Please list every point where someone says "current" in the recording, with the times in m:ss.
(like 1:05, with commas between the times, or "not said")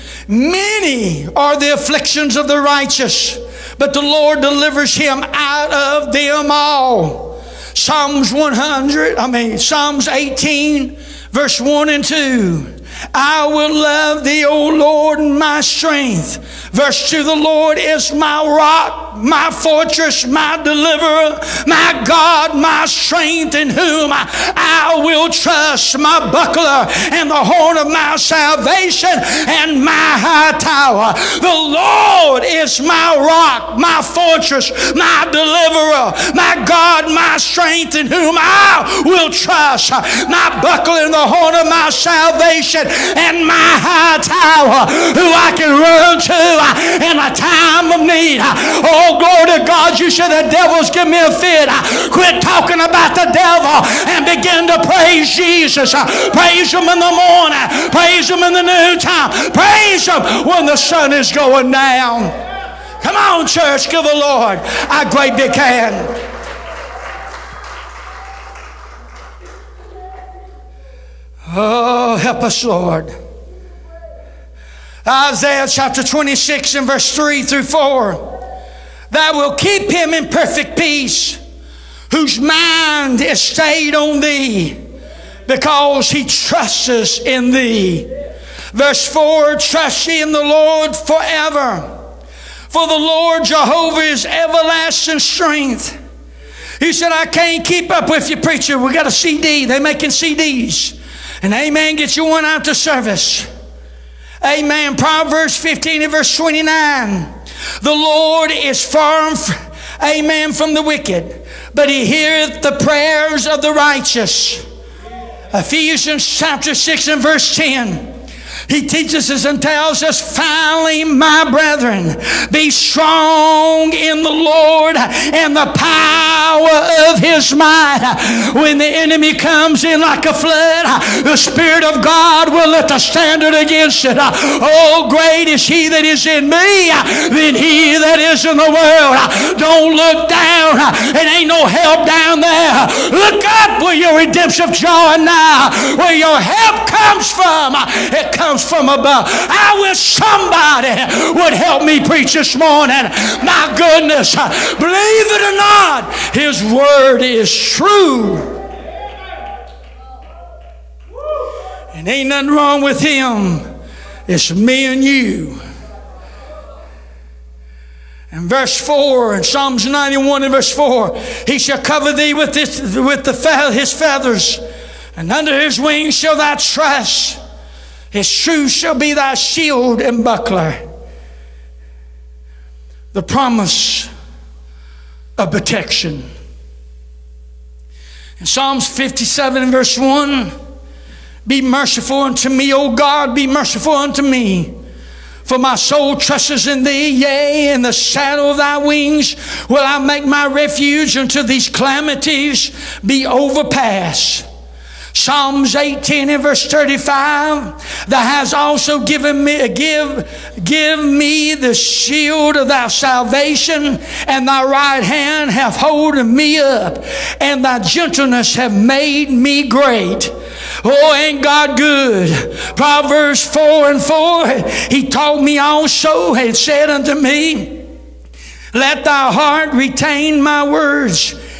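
not said.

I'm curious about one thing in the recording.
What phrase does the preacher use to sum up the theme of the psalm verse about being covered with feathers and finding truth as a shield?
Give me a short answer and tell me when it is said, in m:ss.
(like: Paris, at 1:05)
The promise of protection, at 3:03.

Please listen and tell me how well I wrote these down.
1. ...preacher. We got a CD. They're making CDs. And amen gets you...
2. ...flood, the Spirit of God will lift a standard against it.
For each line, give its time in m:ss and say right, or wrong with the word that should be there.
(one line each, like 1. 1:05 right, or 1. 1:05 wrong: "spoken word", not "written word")
1. 1:38 right
2. 2:10 right.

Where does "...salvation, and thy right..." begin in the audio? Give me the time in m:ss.
3:32.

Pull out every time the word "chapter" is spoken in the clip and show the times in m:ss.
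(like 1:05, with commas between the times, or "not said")
1:15, 1:56.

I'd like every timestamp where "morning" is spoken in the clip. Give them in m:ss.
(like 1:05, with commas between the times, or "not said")
0:57, 2:32.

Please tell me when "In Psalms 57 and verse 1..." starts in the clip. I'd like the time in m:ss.
3:08.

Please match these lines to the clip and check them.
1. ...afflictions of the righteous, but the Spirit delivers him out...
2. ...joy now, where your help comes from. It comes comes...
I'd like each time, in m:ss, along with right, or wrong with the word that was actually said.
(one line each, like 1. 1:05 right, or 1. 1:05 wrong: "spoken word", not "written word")
1. 0:01 wrong: "Lord", not "Spirit"
2. 2:24 right.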